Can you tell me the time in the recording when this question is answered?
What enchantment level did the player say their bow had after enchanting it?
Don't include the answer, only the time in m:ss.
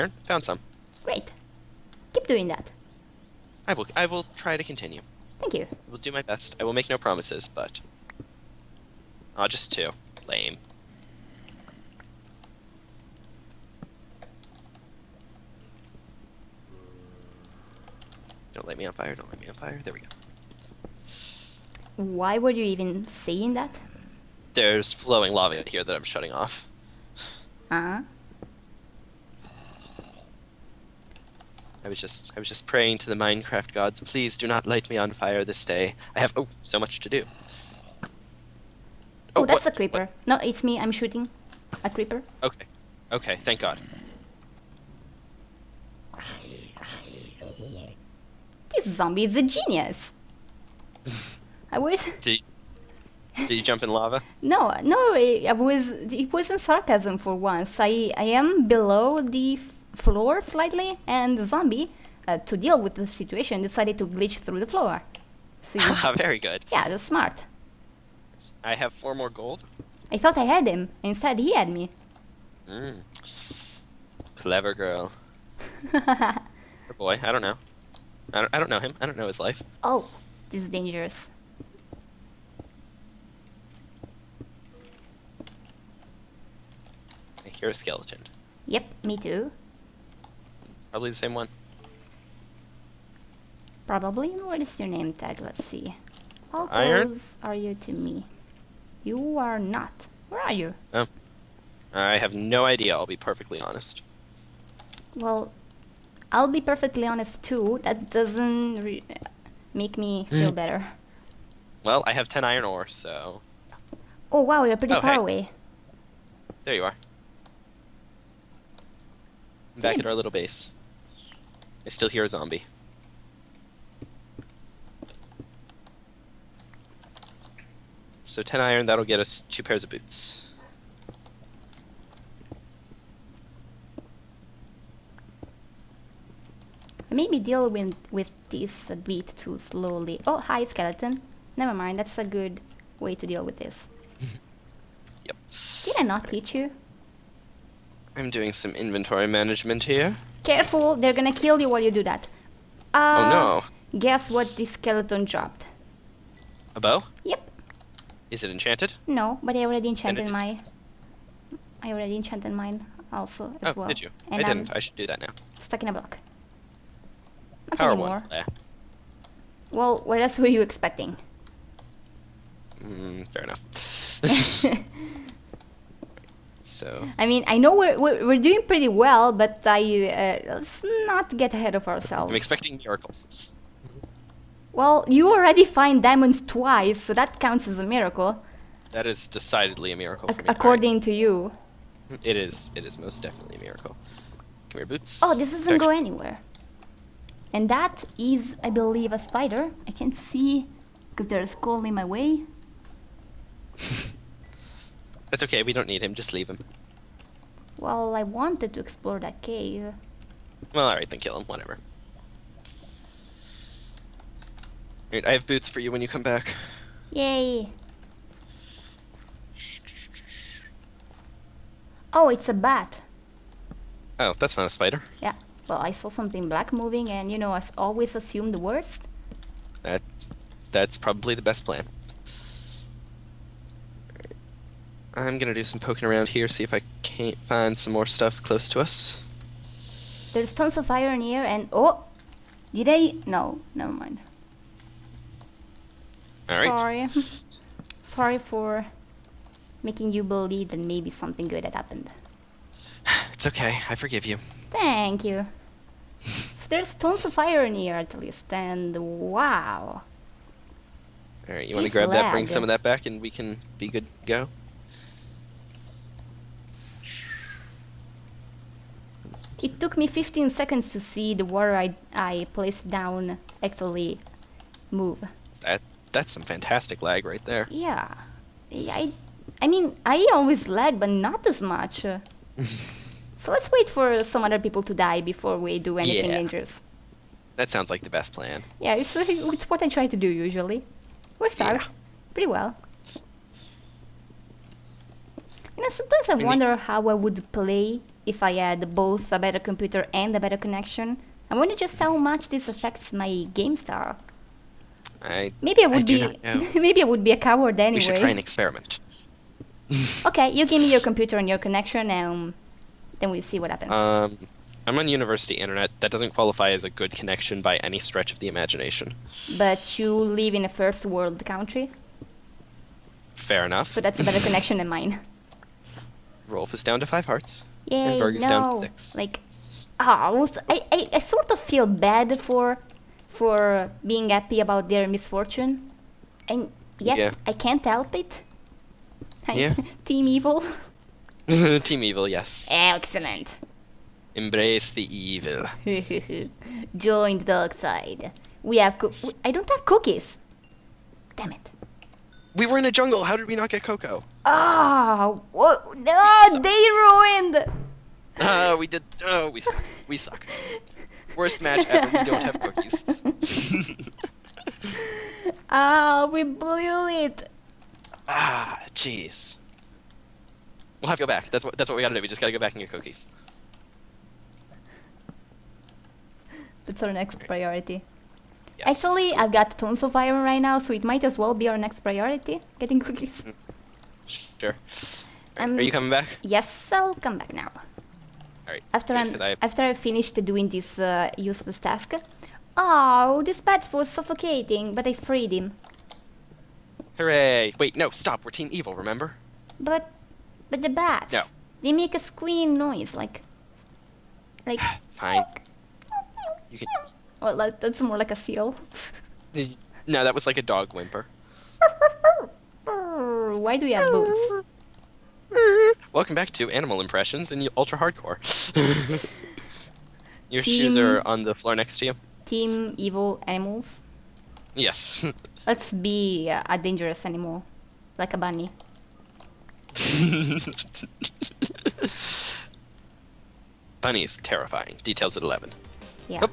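2:47.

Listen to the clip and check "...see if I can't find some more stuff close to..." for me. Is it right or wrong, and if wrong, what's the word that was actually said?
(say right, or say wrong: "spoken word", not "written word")
right.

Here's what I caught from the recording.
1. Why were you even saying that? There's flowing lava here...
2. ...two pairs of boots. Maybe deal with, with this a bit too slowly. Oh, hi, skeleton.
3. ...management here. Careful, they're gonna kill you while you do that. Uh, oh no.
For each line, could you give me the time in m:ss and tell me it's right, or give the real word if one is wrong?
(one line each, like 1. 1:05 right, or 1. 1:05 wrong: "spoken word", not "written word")
1. 0:21 right
2. 2:09 right
3. 2:29 right.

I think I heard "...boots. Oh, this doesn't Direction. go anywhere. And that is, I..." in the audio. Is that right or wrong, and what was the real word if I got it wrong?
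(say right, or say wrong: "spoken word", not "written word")
right.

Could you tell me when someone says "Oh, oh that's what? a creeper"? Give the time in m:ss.
0:39.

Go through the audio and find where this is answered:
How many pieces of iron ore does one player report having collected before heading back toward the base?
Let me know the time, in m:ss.
1:52.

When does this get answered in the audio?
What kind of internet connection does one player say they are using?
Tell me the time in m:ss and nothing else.
5:15.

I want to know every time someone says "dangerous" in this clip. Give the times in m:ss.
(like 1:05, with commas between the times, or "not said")
1:20, 4:46, 7:06.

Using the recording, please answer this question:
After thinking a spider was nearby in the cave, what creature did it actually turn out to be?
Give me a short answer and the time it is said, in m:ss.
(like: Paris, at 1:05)
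A bat, at 3:42.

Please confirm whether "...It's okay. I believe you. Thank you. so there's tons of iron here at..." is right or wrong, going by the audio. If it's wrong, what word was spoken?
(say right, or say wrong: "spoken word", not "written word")
wrong: "forgive", not "believe".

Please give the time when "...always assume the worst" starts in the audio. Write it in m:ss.
3:47.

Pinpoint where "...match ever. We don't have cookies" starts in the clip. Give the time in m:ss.
6:01.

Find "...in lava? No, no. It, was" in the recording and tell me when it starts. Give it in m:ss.
0:53.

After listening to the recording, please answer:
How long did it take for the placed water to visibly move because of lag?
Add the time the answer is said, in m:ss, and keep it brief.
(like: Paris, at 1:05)
15 seconds, at 4:30.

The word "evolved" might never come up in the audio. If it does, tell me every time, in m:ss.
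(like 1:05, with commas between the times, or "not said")
not said.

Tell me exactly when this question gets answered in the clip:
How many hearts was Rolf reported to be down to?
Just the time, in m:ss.
5:27.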